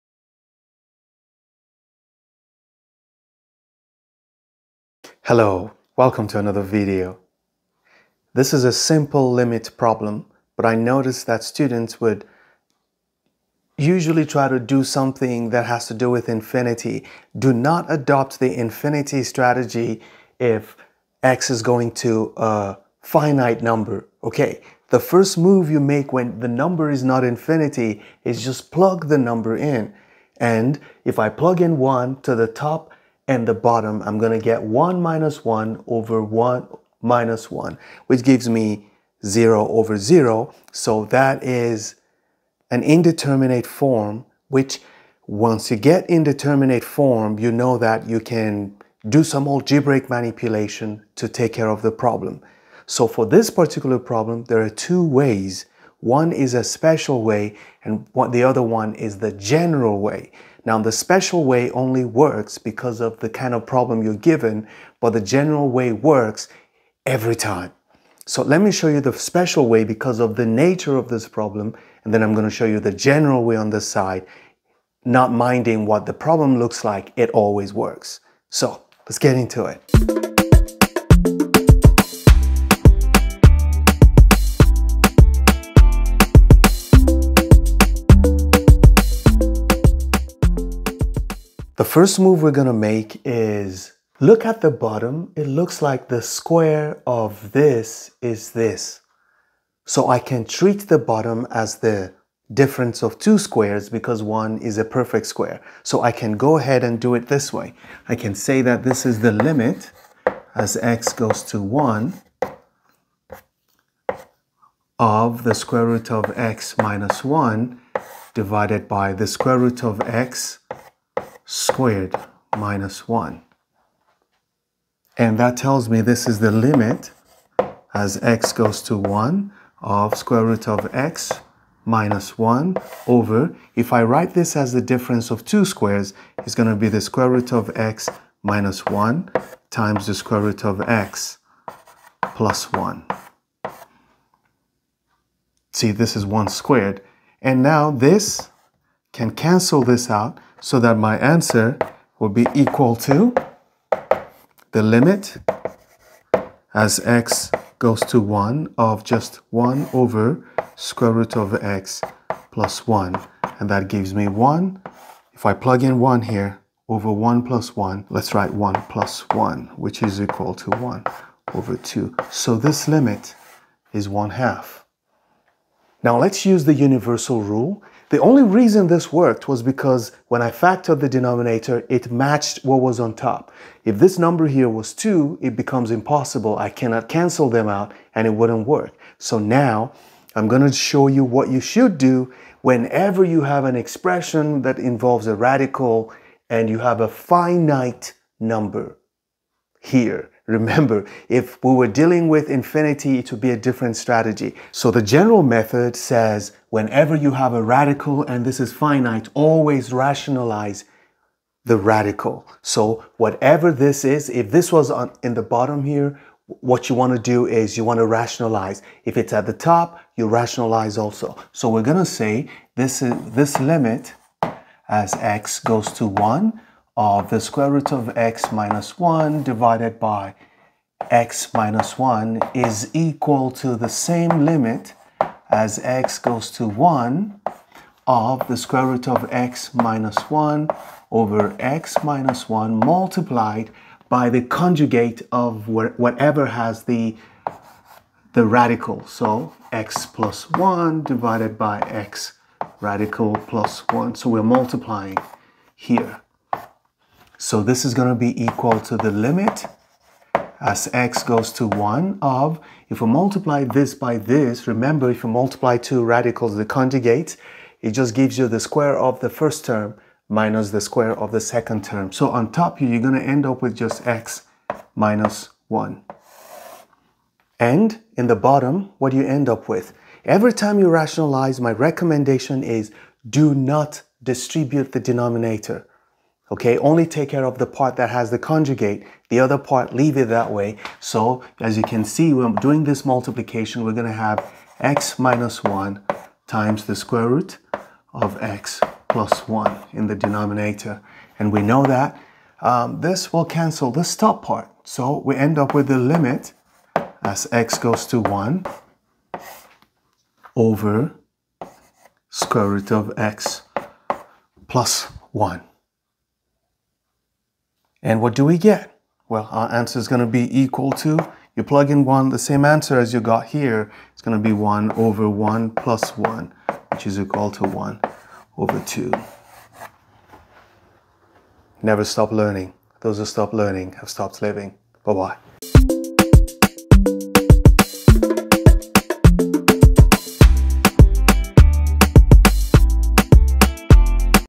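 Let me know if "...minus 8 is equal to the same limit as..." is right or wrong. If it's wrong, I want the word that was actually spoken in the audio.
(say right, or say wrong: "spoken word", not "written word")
wrong: "1", not "8".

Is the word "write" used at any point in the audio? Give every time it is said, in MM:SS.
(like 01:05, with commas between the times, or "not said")
02:14, 02:48.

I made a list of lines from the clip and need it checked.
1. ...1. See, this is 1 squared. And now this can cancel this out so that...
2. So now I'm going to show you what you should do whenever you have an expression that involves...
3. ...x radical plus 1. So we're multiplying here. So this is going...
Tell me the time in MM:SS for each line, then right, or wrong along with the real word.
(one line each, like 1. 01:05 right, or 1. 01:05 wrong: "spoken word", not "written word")
1. 02:22 right
2. 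03:09 right
3. 04:11 right.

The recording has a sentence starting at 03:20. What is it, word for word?
Remember, if we were dealing with infinity, it would be a different strategy.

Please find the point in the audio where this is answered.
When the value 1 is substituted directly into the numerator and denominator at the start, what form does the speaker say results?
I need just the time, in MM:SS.
00:39.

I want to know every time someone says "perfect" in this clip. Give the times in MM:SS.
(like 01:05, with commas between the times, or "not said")
01:44.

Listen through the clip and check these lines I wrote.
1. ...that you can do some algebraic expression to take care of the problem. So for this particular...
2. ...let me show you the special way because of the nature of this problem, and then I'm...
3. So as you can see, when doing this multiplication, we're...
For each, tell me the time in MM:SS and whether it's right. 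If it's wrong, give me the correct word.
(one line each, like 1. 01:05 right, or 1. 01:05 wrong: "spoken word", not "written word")
1. 00:47 wrong: "manipulation", not "expression"
2. 01:08 right
3. 04:50 right.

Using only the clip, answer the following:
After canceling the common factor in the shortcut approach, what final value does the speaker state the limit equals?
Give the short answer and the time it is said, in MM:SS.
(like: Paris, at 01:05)
1 half, at 02:54.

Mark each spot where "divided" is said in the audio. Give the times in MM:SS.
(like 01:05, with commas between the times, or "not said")
01:58, 03:49, 04:11.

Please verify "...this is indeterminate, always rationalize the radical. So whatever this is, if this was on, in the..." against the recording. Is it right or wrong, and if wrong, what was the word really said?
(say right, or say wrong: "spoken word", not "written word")
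wrong: "finite", not "indeterminate".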